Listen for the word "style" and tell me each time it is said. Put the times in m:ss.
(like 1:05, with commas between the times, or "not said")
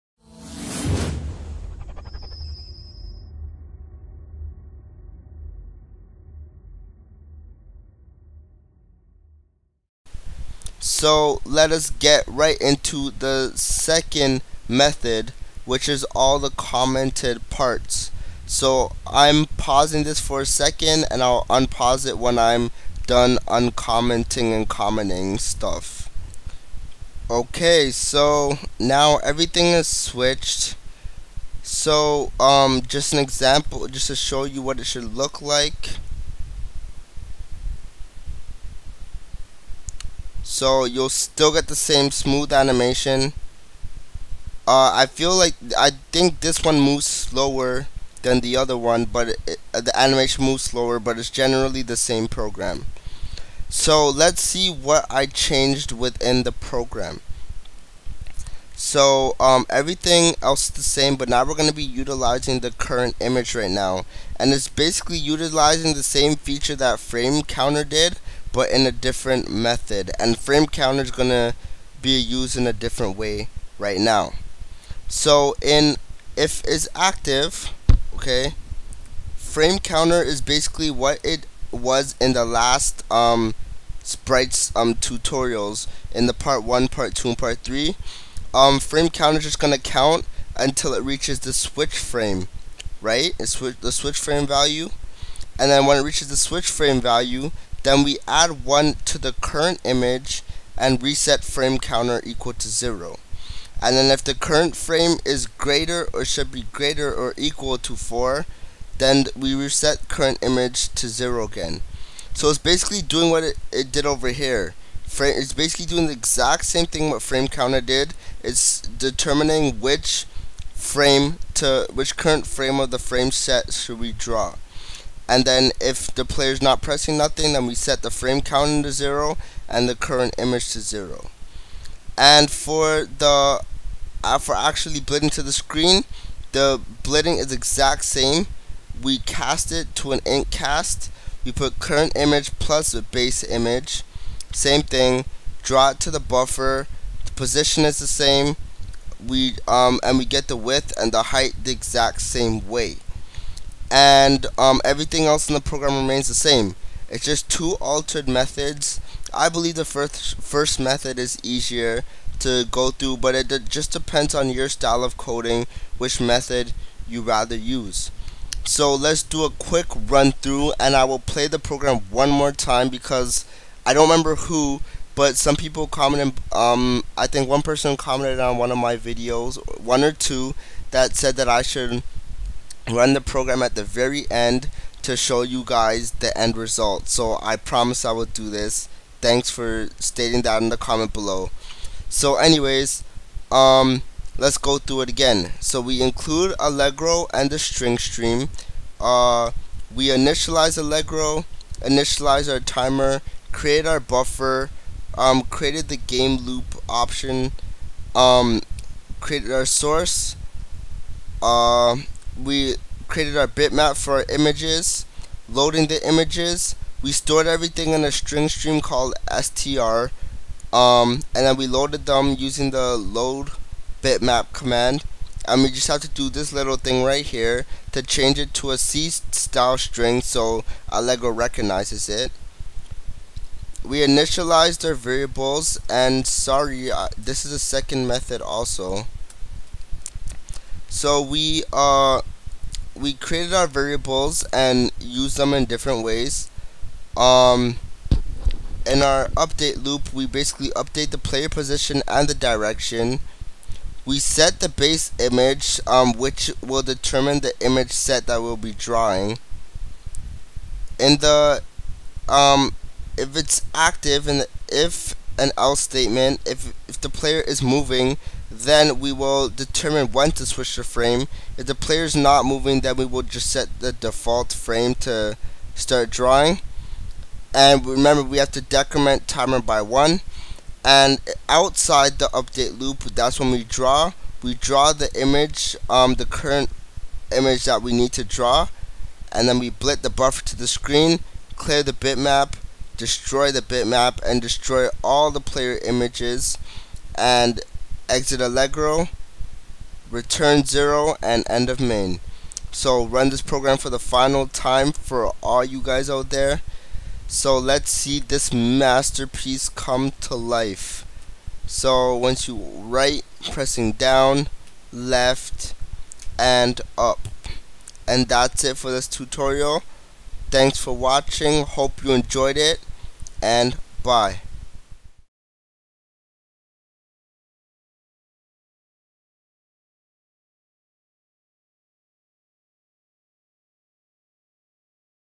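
2:44, 3:49.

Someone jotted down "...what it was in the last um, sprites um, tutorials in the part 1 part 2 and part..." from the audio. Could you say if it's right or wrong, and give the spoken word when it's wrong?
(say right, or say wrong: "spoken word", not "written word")
right.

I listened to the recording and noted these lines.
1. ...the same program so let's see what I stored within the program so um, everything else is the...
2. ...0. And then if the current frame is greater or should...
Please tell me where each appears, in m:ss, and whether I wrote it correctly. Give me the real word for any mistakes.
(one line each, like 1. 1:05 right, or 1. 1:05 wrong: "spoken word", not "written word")
1. 0:51 wrong: "changed", not "stored"
2. 1:42 right.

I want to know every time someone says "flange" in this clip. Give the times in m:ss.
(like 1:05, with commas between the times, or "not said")
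not said.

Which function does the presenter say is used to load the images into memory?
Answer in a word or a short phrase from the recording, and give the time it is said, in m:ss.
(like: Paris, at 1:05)
load bitmap, at 3:42.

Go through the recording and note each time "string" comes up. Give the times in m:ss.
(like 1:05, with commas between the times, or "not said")
3:17, 3:38, 3:49.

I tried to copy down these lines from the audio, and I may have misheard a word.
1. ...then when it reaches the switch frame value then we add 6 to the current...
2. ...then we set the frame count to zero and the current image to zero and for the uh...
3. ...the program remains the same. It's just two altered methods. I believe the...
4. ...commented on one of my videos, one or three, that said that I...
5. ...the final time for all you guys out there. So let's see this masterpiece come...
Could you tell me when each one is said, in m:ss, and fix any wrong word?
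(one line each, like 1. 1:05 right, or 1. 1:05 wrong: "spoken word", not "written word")
1. 1:35 wrong: "1", not "6"
2. 2:07 right
3. 2:35 right
4. 2:57 wrong: "two", not "three"
5. 5:03 right.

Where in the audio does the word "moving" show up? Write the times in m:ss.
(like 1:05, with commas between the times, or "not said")
4:27, 4:32.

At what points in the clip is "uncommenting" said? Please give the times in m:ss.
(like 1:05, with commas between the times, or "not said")
0:23.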